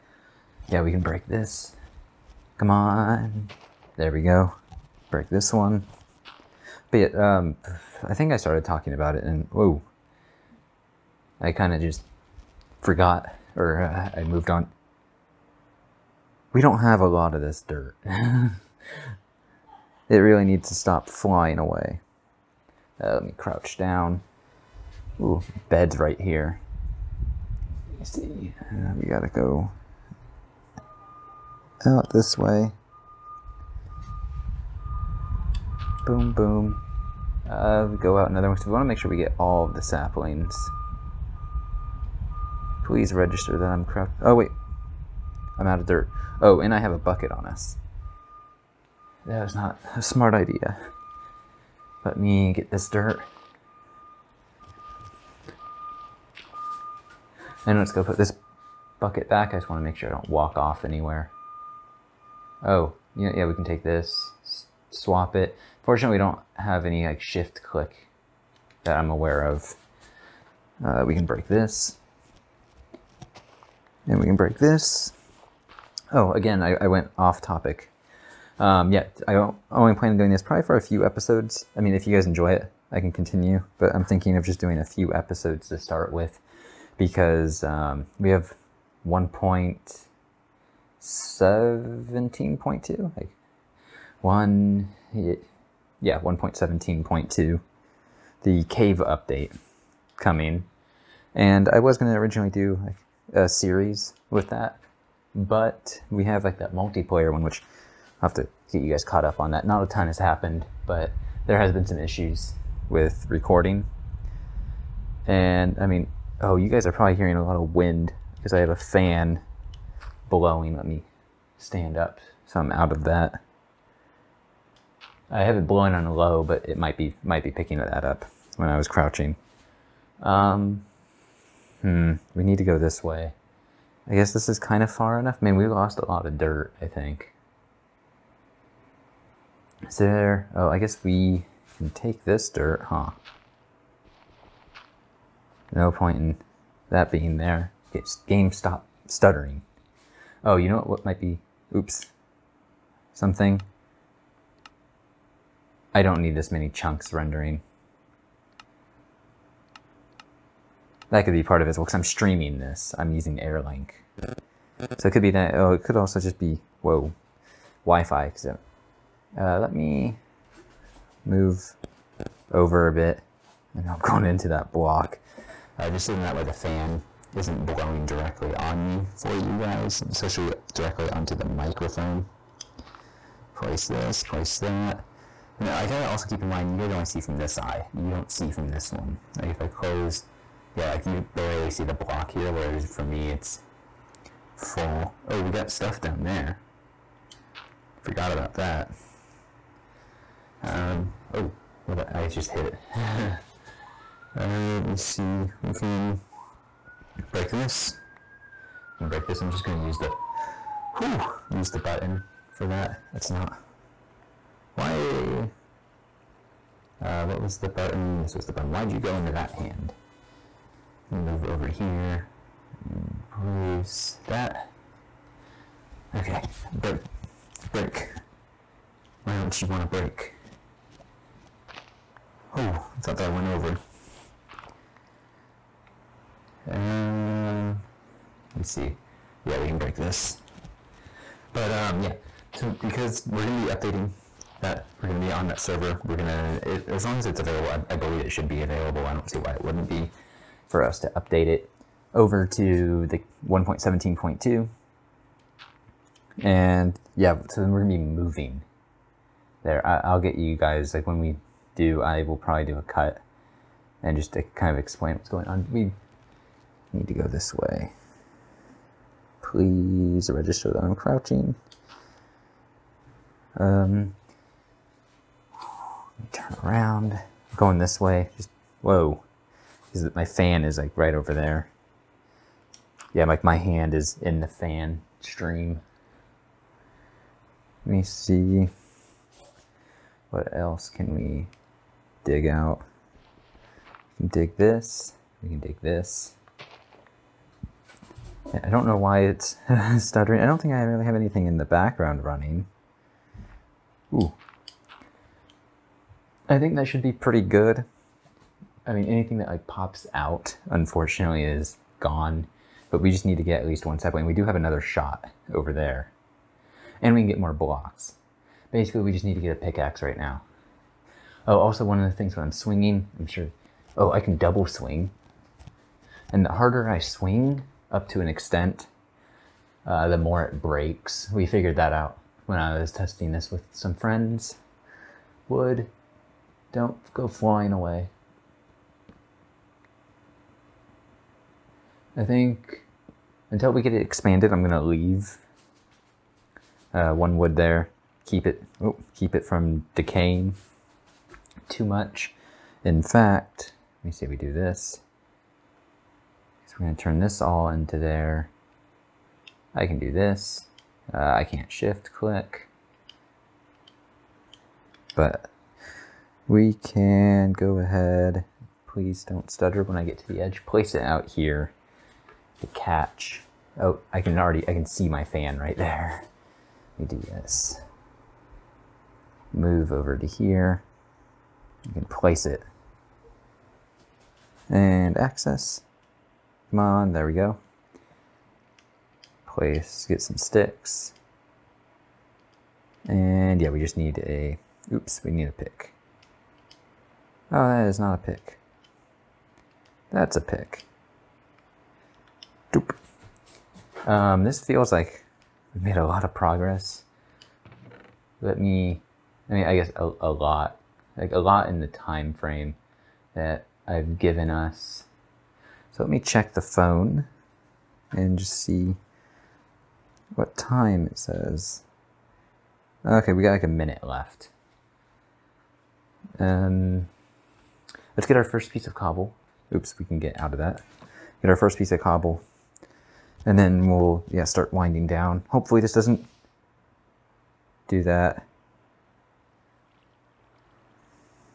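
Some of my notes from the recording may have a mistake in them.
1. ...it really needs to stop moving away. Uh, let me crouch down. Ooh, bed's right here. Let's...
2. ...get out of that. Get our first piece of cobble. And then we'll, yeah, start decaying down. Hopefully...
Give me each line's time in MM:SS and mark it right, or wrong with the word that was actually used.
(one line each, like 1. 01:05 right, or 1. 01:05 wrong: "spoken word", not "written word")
1. 00:20 wrong: "flying", not "moving"
2. 07:10 wrong: "winding", not "decaying".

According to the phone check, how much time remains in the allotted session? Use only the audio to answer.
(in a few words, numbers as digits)
1 minute.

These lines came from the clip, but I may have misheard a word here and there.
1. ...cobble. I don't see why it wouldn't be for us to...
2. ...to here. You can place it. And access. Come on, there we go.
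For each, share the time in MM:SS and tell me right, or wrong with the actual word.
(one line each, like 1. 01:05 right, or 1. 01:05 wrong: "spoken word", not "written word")
1. 04:08 wrong: "available", not "cobble"
2. 06:20 right.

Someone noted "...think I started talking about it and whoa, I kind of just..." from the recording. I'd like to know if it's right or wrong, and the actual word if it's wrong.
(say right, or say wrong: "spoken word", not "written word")
right.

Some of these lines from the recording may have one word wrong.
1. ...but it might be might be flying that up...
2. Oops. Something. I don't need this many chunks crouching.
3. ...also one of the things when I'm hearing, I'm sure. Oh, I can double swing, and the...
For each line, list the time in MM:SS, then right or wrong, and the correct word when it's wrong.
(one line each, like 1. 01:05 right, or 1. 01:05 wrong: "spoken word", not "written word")
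1. 02:06 wrong: "picking", not "flying"
2. 02:31 wrong: "rendering", not "crouching"
3. 05:21 wrong: "swinging", not "hearing".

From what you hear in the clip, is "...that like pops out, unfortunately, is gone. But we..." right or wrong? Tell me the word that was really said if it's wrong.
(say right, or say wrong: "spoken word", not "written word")
right.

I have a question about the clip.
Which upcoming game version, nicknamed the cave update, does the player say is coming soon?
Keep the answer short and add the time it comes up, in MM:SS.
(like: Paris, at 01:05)
1.17.2, at 01:36.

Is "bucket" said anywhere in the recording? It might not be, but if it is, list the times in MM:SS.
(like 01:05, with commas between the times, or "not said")
00:46, 00:58.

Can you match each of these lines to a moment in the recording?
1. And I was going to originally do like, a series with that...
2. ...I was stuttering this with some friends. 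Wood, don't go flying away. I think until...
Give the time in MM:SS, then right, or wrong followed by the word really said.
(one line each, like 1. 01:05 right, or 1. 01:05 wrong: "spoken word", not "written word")
1. 01:41 right
2. 05:32 wrong: "testing", not "stuttering".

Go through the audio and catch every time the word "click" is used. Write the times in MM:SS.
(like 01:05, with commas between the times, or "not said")
01:07, 06:02.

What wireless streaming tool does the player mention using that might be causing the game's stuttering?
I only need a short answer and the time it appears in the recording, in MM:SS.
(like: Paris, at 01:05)
Airlink, at 02:43.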